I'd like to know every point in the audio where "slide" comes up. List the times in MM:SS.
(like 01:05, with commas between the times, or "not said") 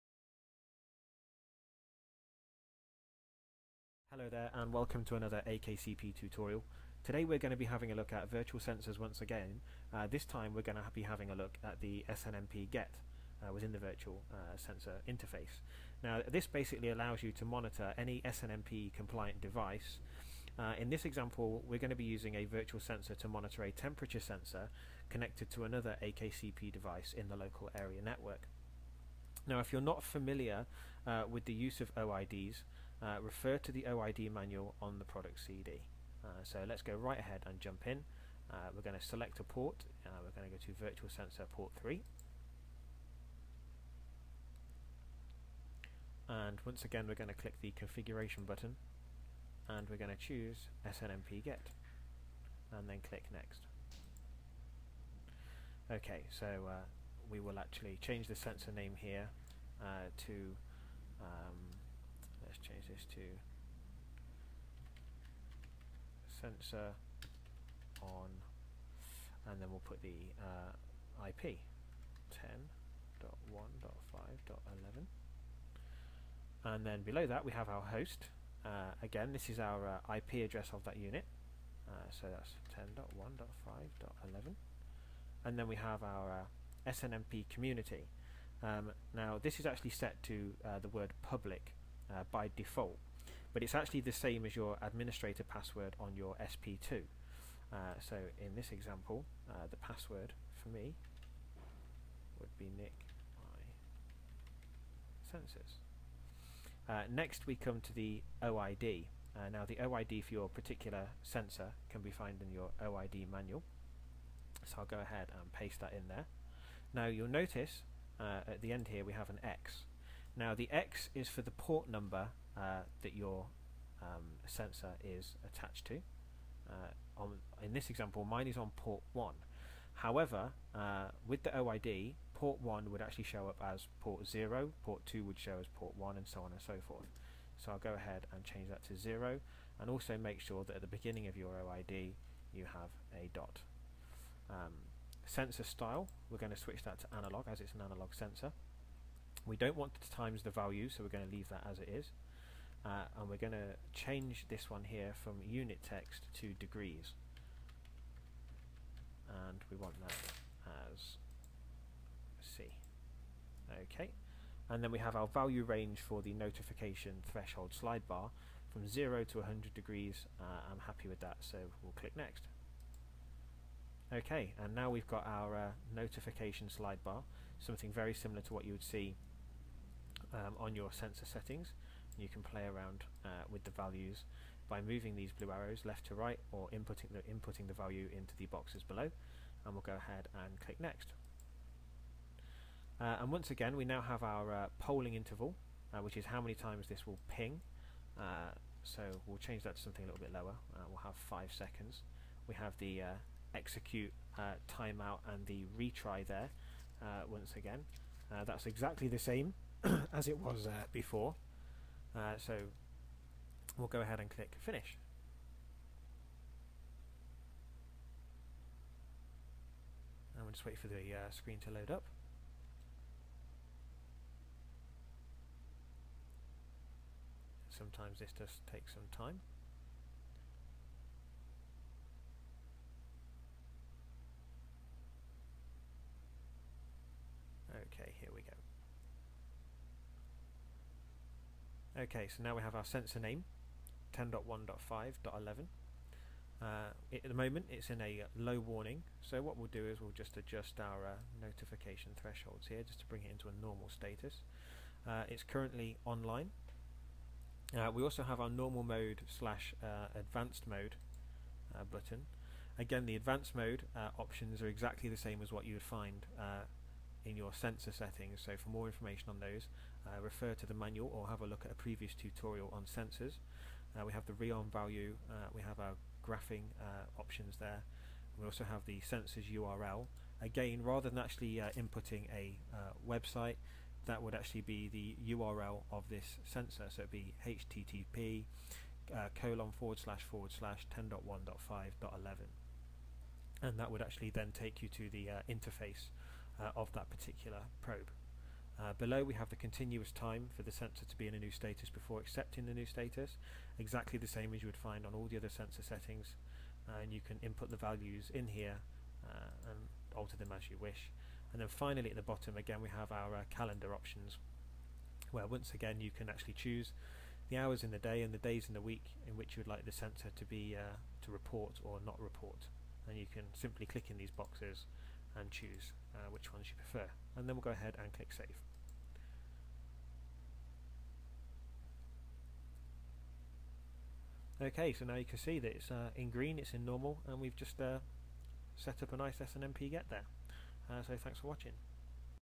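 02:47, 02:56.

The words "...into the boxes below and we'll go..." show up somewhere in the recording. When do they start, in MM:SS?
03:08.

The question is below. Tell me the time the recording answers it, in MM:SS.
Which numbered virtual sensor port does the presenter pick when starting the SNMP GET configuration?
00:40.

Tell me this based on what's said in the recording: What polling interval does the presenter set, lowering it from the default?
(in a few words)
5 seconds.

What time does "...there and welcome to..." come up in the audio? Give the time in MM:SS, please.
00:04.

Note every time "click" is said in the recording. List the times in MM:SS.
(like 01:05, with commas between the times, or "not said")
00:47, 00:53, 02:51, 03:10, 03:34, 05:23, 05:28.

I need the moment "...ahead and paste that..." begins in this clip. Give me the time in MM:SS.
01:54.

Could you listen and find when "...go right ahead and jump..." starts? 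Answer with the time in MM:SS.
00:36.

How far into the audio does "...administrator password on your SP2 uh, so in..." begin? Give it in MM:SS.
01:34.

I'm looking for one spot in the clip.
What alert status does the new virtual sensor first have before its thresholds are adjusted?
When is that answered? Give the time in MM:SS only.
04:08.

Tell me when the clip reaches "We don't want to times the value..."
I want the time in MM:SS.
02:29.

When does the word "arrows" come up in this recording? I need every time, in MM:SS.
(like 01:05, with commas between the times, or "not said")
03:05.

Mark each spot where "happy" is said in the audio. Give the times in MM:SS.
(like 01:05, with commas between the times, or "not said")
02:50.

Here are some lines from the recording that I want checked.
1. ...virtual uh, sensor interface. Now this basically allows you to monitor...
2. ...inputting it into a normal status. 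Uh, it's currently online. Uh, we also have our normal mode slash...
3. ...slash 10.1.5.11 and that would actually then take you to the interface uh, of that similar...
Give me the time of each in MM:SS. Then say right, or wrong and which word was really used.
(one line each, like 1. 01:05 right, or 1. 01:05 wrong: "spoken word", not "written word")
1. 00:13 right
2. 04:13 wrong: "bring", not "inputting"
3. 04:50 wrong: "particular", not "similar".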